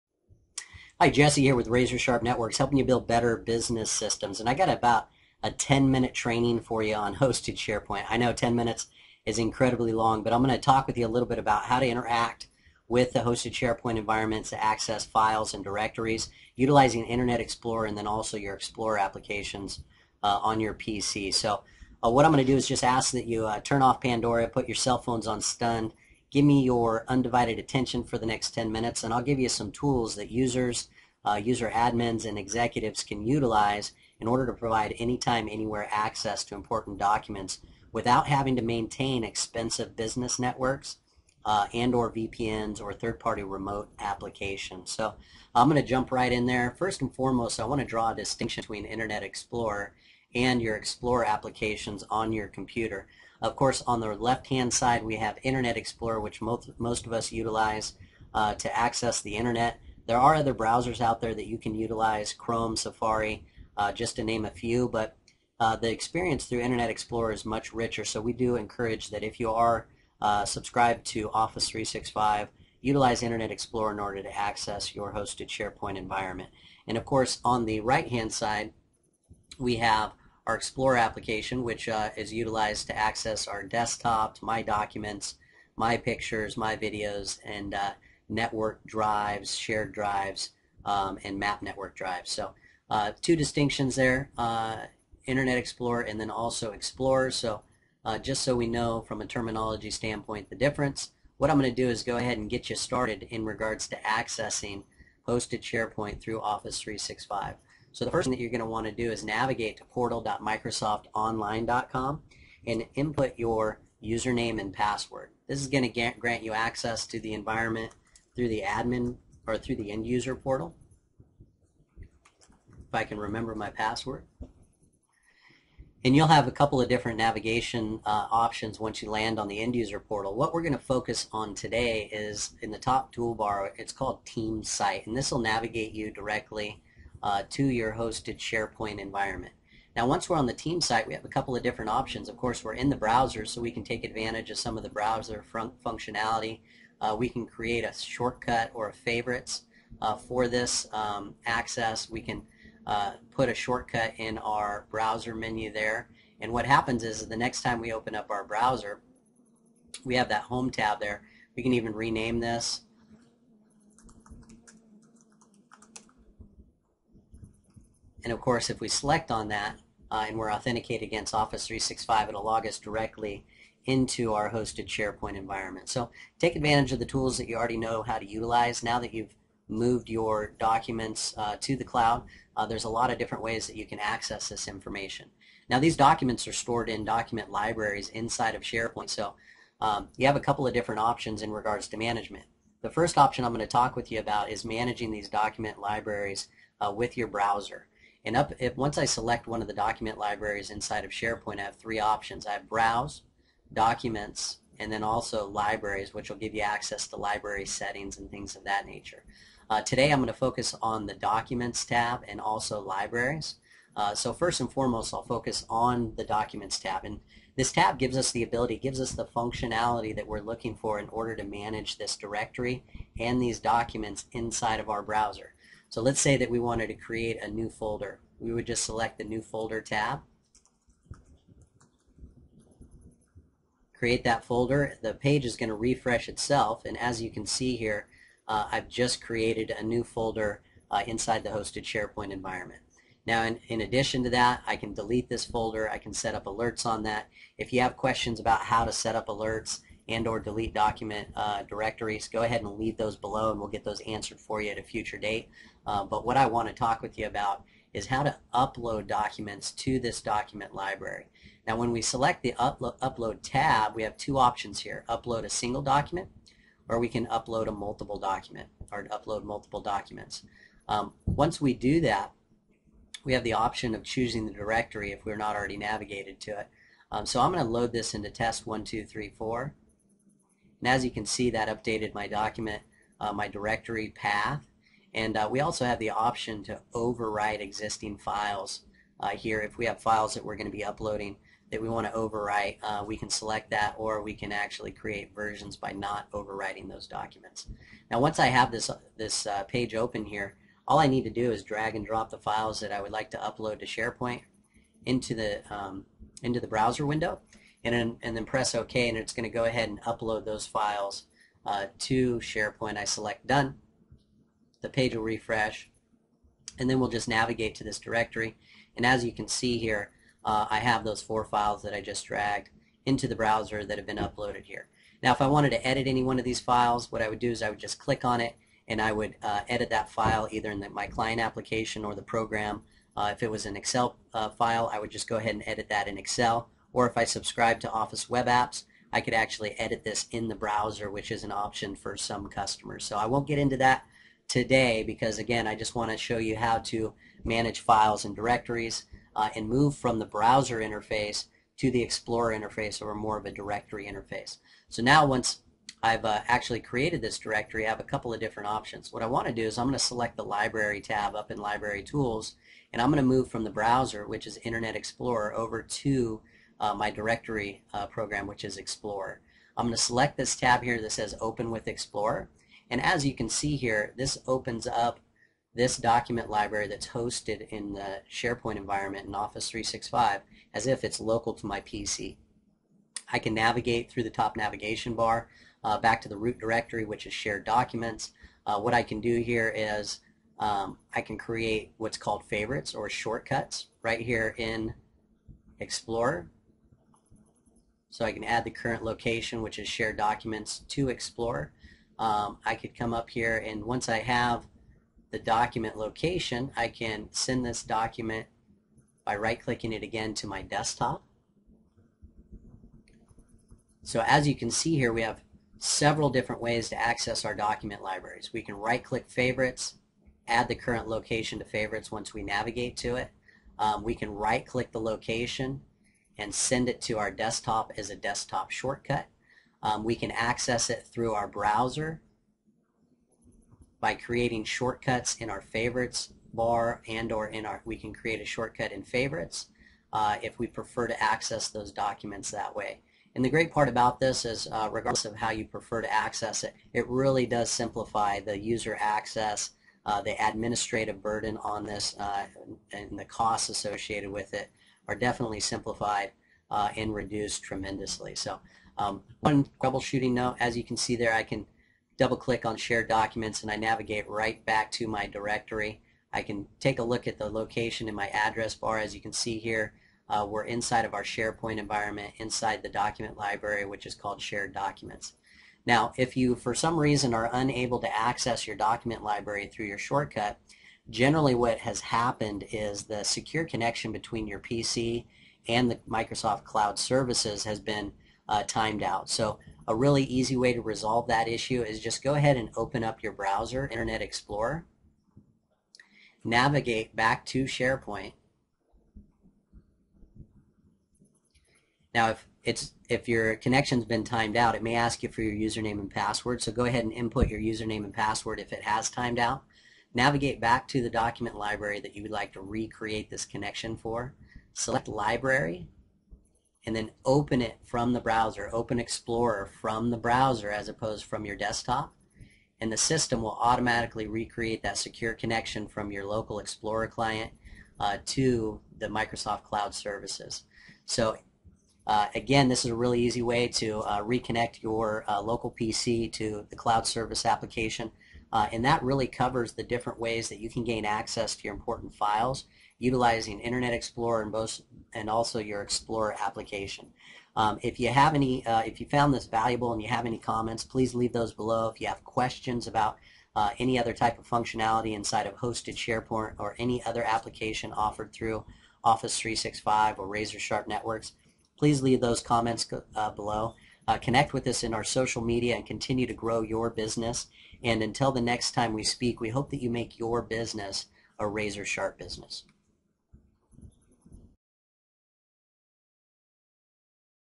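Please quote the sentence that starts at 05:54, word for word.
So now once I've uh, actually created this directory I have a couple of different options.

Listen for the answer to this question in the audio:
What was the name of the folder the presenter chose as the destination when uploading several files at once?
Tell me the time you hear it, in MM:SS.
04:38.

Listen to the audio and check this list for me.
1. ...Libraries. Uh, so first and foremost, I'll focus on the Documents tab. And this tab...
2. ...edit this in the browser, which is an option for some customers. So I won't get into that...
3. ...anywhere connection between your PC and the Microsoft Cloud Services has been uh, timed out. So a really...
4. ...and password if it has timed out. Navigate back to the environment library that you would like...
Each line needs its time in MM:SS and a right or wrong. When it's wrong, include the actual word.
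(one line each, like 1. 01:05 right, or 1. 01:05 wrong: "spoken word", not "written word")
1. 03:32 right
2. 05:39 right
3. 08:03 wrong: "secure", not "anywhere"
4. 08:28 wrong: "document", not "environment".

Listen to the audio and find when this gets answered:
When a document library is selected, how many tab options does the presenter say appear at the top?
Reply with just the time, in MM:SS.
03:21.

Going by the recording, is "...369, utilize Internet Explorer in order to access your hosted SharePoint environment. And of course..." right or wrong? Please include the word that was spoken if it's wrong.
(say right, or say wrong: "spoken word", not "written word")
wrong: "365", not "369".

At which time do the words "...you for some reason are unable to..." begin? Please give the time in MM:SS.
07:56.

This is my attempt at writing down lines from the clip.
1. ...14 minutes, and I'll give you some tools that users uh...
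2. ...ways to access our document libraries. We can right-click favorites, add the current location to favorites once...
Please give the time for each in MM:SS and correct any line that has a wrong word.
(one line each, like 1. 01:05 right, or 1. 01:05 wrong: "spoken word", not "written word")
1. 00:28 wrong: "10", not "14"
2. 06:56 right.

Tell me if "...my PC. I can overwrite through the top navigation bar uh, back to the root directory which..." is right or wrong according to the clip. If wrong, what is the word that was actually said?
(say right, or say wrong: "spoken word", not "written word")
wrong: "navigate", not "overwrite".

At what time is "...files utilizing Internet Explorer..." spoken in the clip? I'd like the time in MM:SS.
09:02.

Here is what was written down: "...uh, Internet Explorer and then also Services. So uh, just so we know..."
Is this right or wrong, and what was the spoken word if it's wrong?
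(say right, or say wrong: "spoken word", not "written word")
wrong: "Explorer", not "Services".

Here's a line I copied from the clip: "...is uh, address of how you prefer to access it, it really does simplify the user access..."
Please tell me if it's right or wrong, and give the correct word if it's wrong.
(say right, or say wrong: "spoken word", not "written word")
wrong: "regardless", not "address".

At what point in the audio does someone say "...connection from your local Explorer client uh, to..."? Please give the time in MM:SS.
08:45.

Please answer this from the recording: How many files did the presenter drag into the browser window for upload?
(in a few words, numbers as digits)
4.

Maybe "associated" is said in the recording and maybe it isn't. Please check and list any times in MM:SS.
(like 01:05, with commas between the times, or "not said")
07:33.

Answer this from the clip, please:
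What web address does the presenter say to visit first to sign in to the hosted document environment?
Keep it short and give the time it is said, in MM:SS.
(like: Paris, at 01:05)
portal.microsoftonline.com, at 01:49.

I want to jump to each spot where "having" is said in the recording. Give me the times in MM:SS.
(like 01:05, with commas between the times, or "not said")
00:38.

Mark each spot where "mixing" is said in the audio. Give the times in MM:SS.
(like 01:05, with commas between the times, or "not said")
not said.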